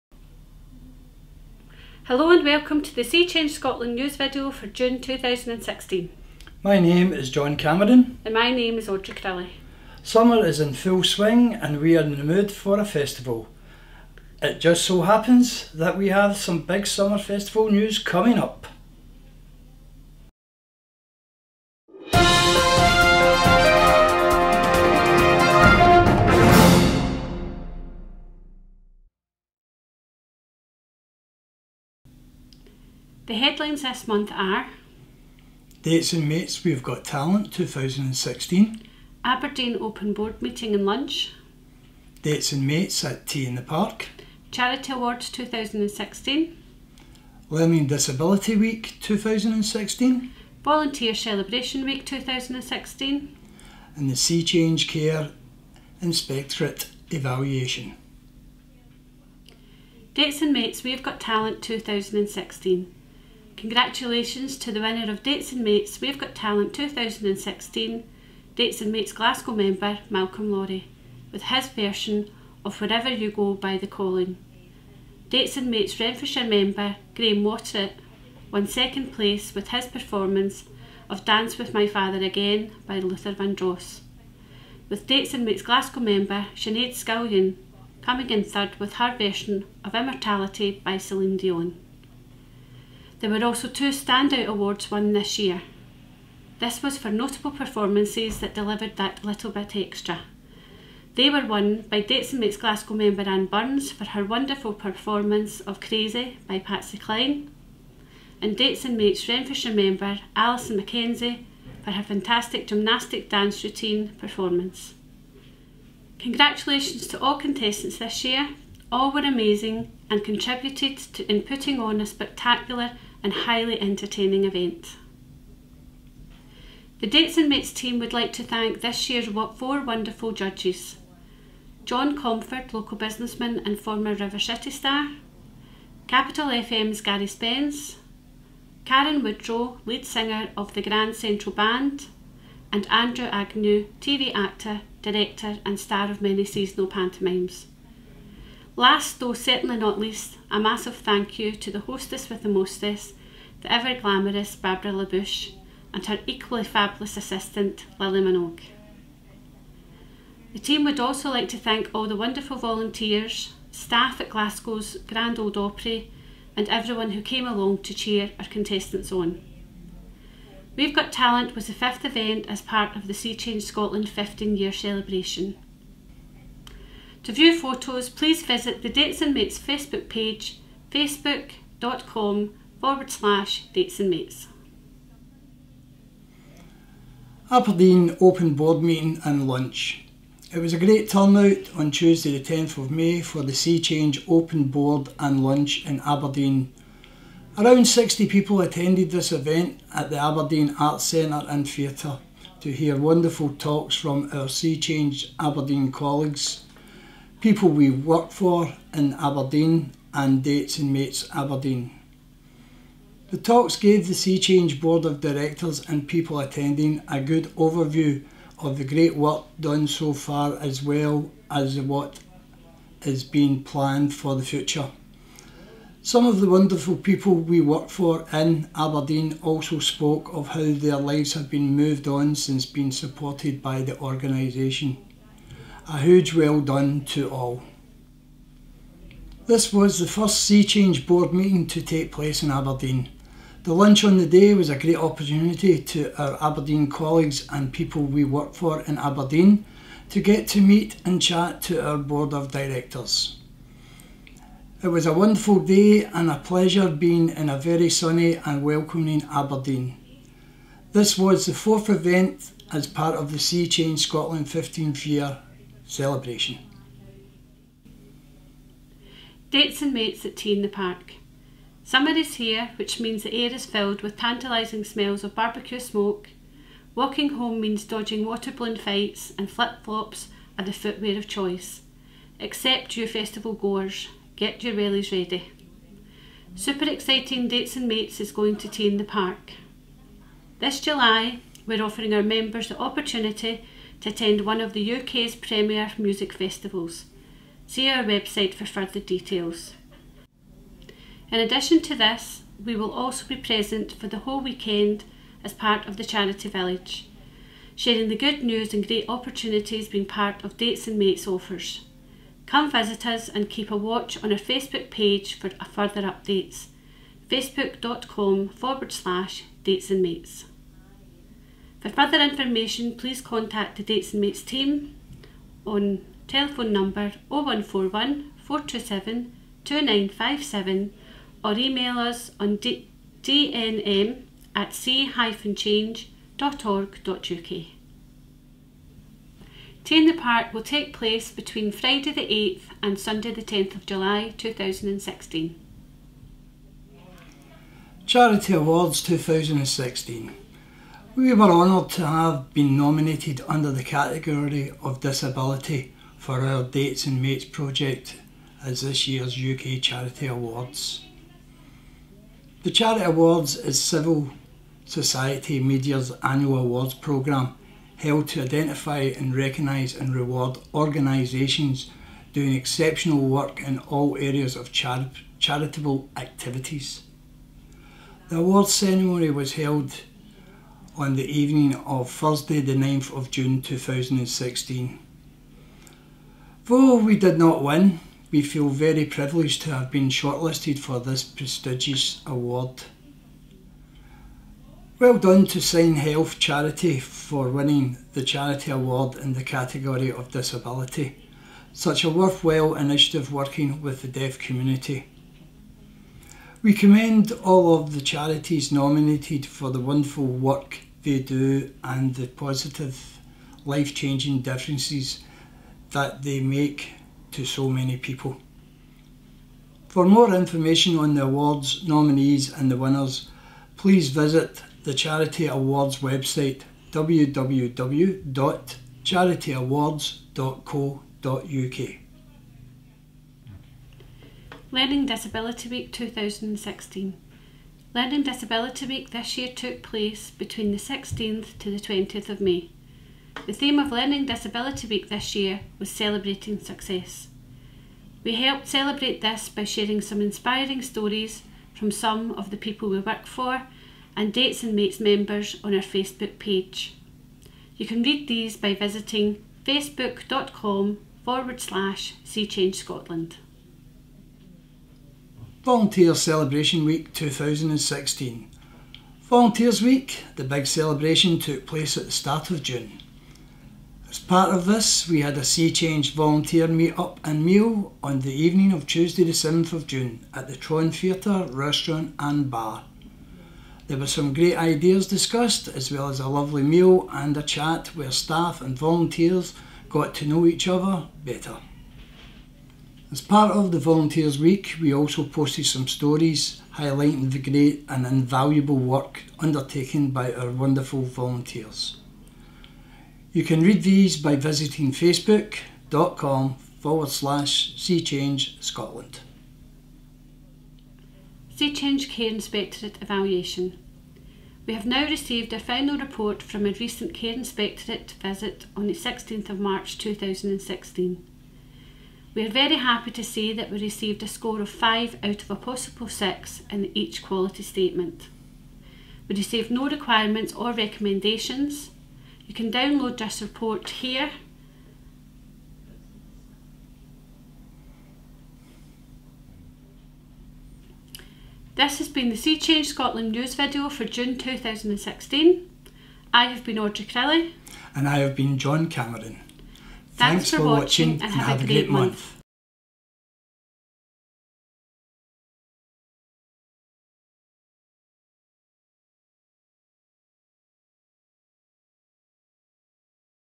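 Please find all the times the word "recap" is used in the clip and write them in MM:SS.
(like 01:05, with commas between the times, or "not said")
not said.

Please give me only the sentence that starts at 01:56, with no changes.
Congratulations to all contestants this year.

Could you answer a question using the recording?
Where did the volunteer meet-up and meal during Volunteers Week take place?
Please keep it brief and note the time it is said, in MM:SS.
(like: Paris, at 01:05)
Tron Theatre, at 08:00.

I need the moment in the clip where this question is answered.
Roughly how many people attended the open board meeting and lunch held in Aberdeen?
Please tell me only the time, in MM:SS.
03:17.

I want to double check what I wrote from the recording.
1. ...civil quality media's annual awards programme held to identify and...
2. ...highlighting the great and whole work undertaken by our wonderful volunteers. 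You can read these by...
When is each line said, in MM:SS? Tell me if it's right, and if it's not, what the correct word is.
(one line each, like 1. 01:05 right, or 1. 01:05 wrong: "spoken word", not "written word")
1. 06:03 wrong: "society", not "quality"
2. 08:16 wrong: "invaluable", not "whole".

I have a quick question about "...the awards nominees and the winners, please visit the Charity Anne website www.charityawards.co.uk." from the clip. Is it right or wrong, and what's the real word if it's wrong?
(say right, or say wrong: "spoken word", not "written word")
wrong: "Awards", not "Anne".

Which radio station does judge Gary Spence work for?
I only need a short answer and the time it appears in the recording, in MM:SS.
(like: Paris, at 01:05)
Capital FM, at 02:16.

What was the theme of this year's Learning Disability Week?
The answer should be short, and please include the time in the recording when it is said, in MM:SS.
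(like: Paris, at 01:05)
celebrating success, at 07:25.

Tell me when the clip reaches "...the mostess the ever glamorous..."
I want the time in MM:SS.
02:32.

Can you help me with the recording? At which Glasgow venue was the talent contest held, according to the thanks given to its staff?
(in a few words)
Grand Ole Opry.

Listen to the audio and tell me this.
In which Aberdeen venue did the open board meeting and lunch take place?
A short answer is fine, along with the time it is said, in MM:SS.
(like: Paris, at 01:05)
Aberdeen Arts Centre and Theatre, at 03:20.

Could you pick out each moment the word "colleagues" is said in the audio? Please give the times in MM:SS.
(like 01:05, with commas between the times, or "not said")
03:25, 04:06.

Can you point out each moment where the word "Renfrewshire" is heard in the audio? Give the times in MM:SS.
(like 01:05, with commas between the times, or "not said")
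01:15, 01:49.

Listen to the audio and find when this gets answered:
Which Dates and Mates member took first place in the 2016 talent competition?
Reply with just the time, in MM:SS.
01:10.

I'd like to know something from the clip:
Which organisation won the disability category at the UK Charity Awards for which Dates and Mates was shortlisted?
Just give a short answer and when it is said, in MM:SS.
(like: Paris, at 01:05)
SignHealth, at 06:35.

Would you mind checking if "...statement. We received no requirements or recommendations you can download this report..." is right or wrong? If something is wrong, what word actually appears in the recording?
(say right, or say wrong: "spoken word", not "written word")
right.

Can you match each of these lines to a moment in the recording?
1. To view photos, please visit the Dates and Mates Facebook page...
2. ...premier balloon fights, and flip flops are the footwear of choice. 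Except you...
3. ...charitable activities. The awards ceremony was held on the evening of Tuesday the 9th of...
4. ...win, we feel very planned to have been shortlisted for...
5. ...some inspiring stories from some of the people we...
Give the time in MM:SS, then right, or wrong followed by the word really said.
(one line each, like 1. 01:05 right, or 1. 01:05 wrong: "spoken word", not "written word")
1. 02:57 right
2. 04:38 wrong: "water", not "premier"
3. 06:15 wrong: "Thursday", not "Tuesday"
4. 06:27 wrong: "privileged", not "planned"
5. 07:30 right.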